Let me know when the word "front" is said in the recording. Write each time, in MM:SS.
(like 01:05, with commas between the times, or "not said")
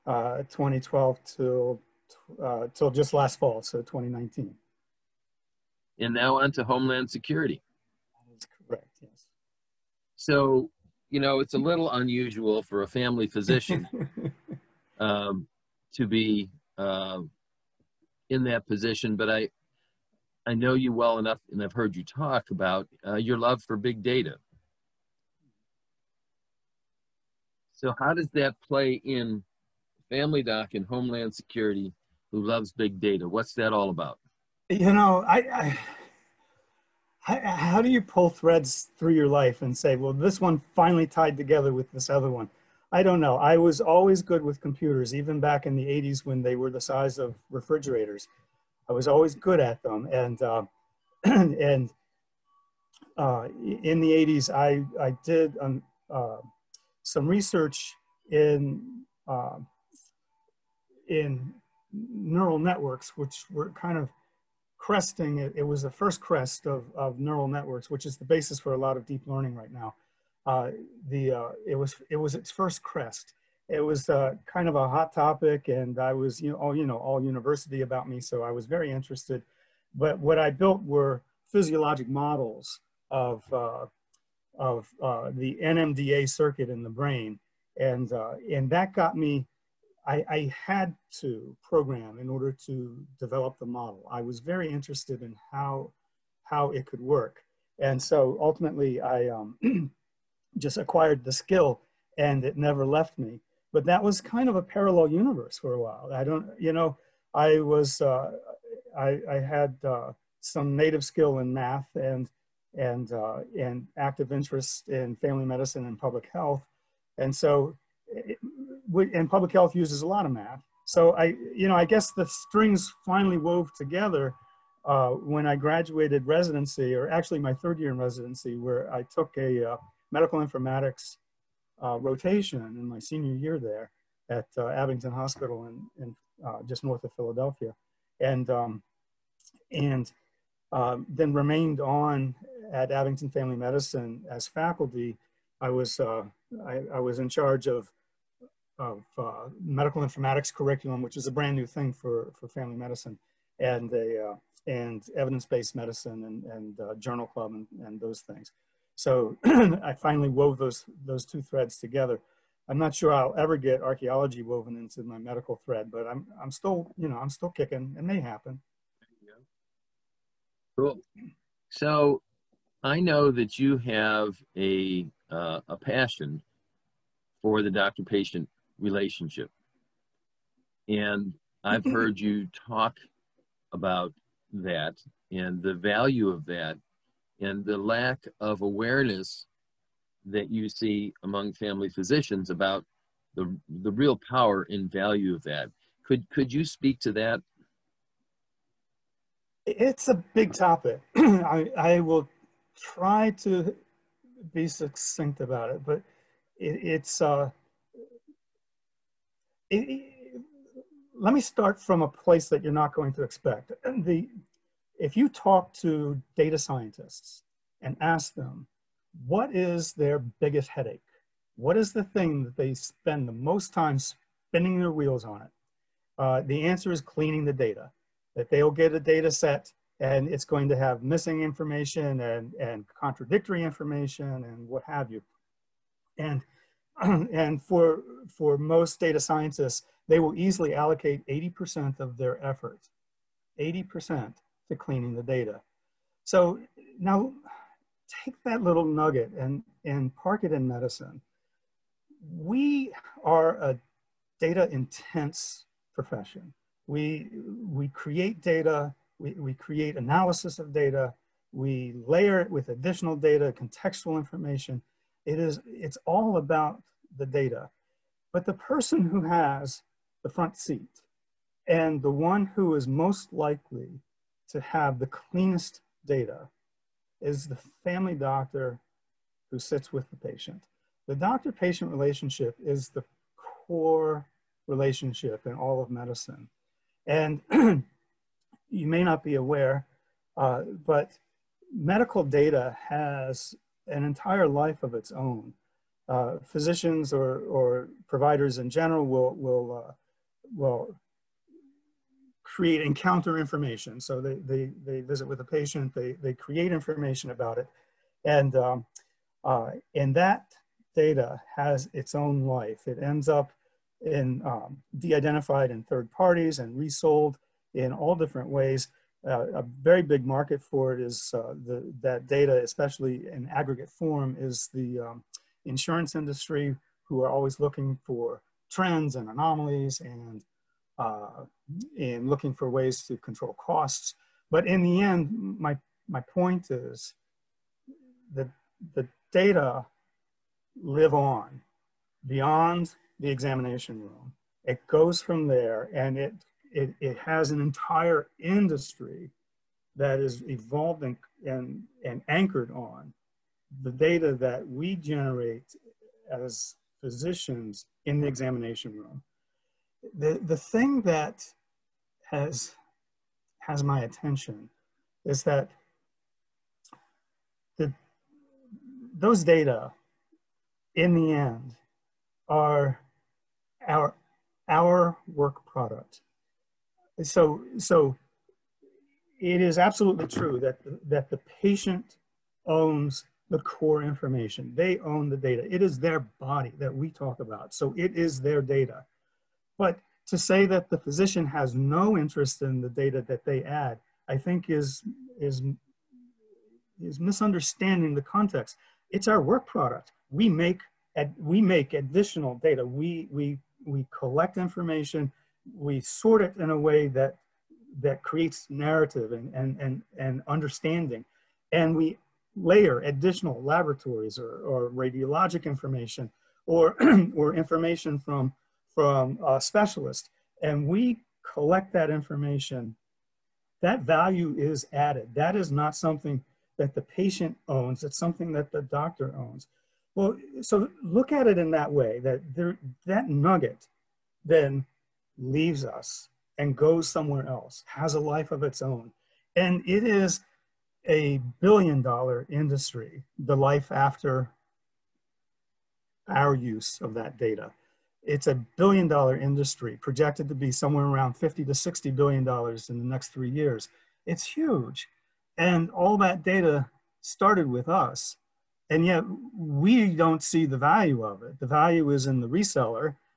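04:30.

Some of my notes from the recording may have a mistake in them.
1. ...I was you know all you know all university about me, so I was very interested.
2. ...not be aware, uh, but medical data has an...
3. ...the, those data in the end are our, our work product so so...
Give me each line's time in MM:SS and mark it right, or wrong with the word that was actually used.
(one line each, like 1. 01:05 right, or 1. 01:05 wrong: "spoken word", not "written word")
1. 01:15 right
2. 04:49 right
3. 06:07 right.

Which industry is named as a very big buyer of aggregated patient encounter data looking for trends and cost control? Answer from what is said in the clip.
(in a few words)
insurance industry.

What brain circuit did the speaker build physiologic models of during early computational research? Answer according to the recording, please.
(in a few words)
NMDA.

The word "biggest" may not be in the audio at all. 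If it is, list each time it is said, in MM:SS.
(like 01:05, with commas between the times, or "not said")
03:40.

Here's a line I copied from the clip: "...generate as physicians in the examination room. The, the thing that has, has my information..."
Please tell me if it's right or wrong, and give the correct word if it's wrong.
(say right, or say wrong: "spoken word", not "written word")
wrong: "attention", not "information".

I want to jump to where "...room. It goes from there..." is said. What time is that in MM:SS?
05:44.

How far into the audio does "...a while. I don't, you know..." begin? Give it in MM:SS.
01:45.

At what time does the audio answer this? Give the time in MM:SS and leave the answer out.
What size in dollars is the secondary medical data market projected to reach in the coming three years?
07:31.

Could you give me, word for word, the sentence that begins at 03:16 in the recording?
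Could, could you speak to that?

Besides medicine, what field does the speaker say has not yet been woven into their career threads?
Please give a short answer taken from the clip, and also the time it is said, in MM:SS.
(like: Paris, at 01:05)
archaeology, at 02:43.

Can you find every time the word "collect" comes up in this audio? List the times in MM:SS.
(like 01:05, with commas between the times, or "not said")
06:44, 07:01.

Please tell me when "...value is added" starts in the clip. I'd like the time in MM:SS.
07:04.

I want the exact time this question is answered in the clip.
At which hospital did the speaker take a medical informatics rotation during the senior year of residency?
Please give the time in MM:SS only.
02:14.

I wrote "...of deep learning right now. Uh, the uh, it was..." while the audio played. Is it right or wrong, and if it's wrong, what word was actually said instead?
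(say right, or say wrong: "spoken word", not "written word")
right.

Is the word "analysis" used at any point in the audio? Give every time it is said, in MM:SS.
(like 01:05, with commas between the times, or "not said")
04:19.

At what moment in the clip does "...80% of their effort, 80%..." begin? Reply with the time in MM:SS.
04:01.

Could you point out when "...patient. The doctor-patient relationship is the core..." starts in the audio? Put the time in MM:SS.
04:40.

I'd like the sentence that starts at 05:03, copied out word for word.
So they, they, they visit with a the patient, they, they create information about it.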